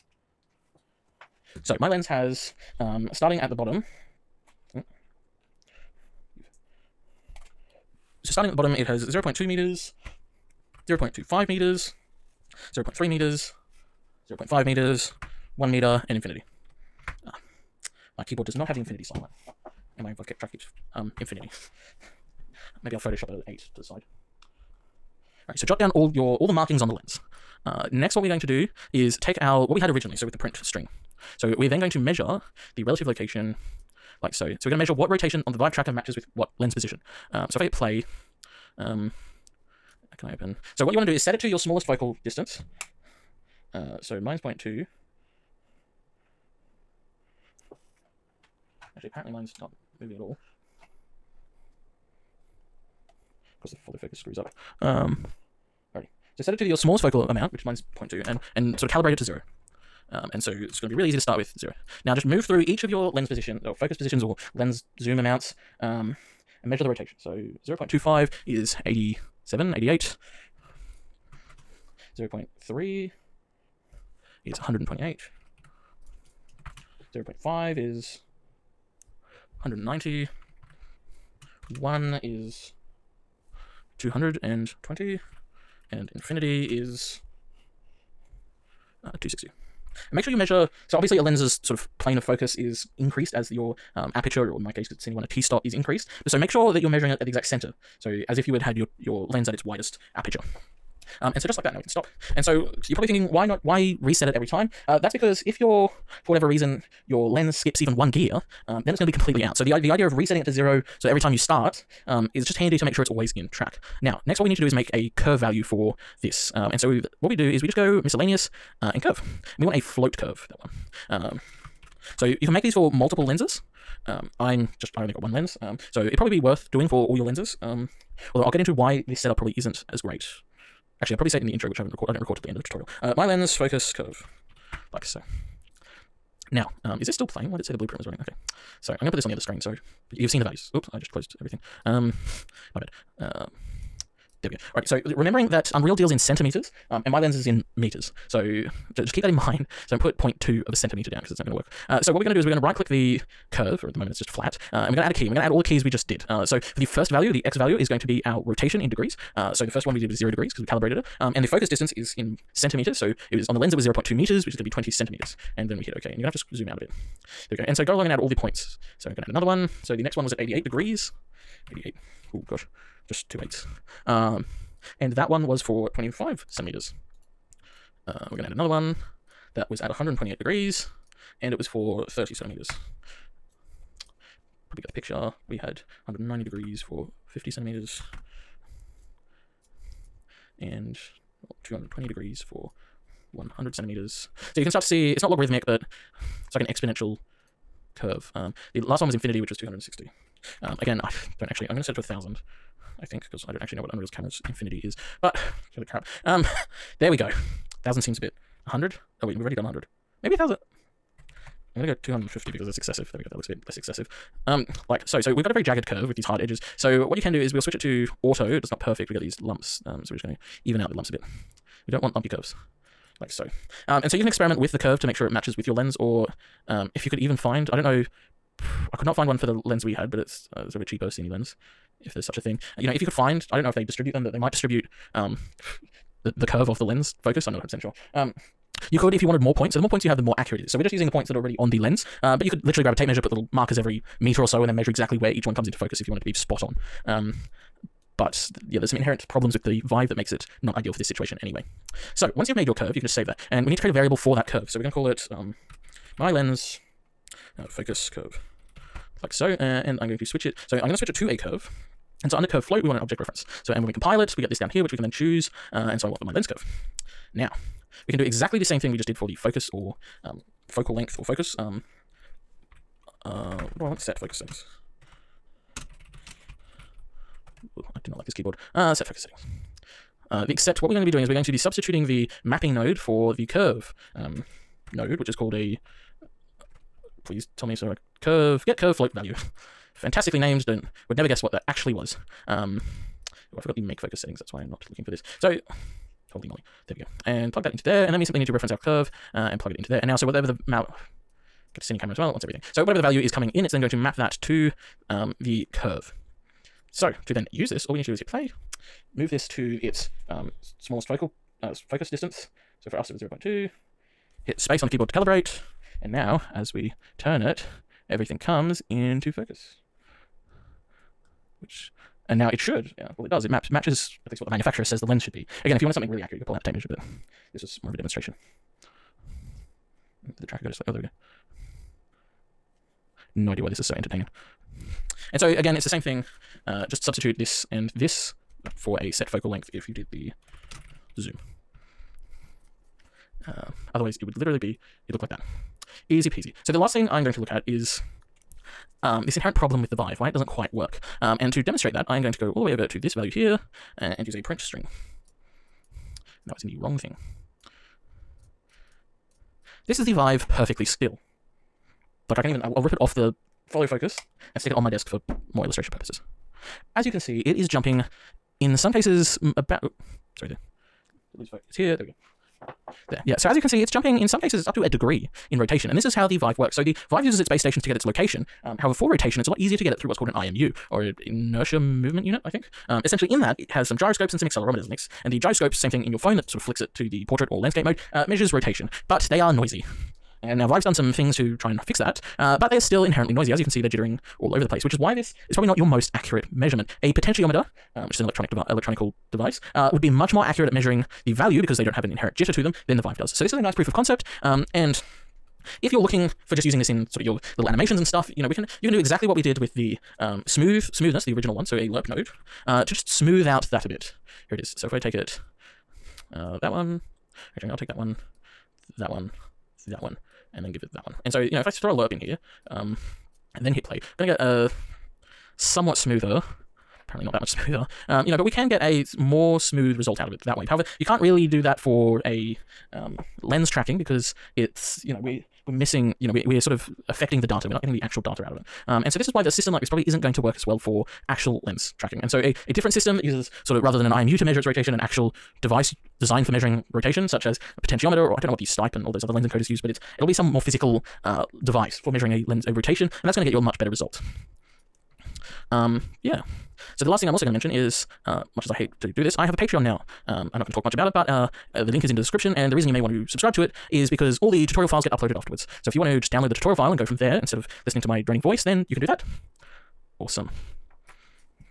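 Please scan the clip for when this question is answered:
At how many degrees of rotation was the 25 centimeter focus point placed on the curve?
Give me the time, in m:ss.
2:50.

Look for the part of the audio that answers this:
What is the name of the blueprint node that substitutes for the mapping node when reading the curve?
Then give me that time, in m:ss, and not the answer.
4:48.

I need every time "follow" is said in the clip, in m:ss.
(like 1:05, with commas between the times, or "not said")
0:53, 6:03.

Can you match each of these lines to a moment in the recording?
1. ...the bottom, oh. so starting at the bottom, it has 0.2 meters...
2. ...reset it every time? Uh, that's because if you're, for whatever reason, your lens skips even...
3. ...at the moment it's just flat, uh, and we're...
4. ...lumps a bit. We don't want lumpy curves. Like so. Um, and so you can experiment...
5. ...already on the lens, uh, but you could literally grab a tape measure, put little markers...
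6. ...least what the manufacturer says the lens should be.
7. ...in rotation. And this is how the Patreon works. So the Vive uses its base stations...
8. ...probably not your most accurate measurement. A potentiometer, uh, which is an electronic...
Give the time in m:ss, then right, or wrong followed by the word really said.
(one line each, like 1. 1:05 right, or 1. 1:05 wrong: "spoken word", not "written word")
1. 0:03 right
2. 1:43 right
3. 2:33 right
4. 3:40 right
5. 4:01 right
6. 5:24 right
7. 6:15 wrong: "Vive", not "Patreon"
8. 6:35 right.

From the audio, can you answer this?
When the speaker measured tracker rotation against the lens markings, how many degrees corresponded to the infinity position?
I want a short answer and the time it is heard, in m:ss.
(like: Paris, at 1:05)
260, at 1:26.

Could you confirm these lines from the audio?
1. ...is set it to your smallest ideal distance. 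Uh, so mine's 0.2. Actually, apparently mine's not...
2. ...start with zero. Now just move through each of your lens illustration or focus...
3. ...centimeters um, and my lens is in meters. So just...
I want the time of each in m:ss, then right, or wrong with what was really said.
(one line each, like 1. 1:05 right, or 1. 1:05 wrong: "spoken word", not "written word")
1. 0:41 wrong: "focal", not "ideal"
2. 1:01 wrong: "position", not "illustration"
3. 2:26 right.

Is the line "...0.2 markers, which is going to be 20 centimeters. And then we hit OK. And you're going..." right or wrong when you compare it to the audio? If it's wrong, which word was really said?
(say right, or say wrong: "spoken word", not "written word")
wrong: "meters", not "markers".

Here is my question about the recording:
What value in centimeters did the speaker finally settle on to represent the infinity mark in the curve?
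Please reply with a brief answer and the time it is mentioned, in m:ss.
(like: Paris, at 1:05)
250, at 3:32.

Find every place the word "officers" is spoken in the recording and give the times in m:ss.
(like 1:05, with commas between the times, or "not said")
not said.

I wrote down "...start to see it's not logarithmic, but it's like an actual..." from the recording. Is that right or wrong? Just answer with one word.
wrong.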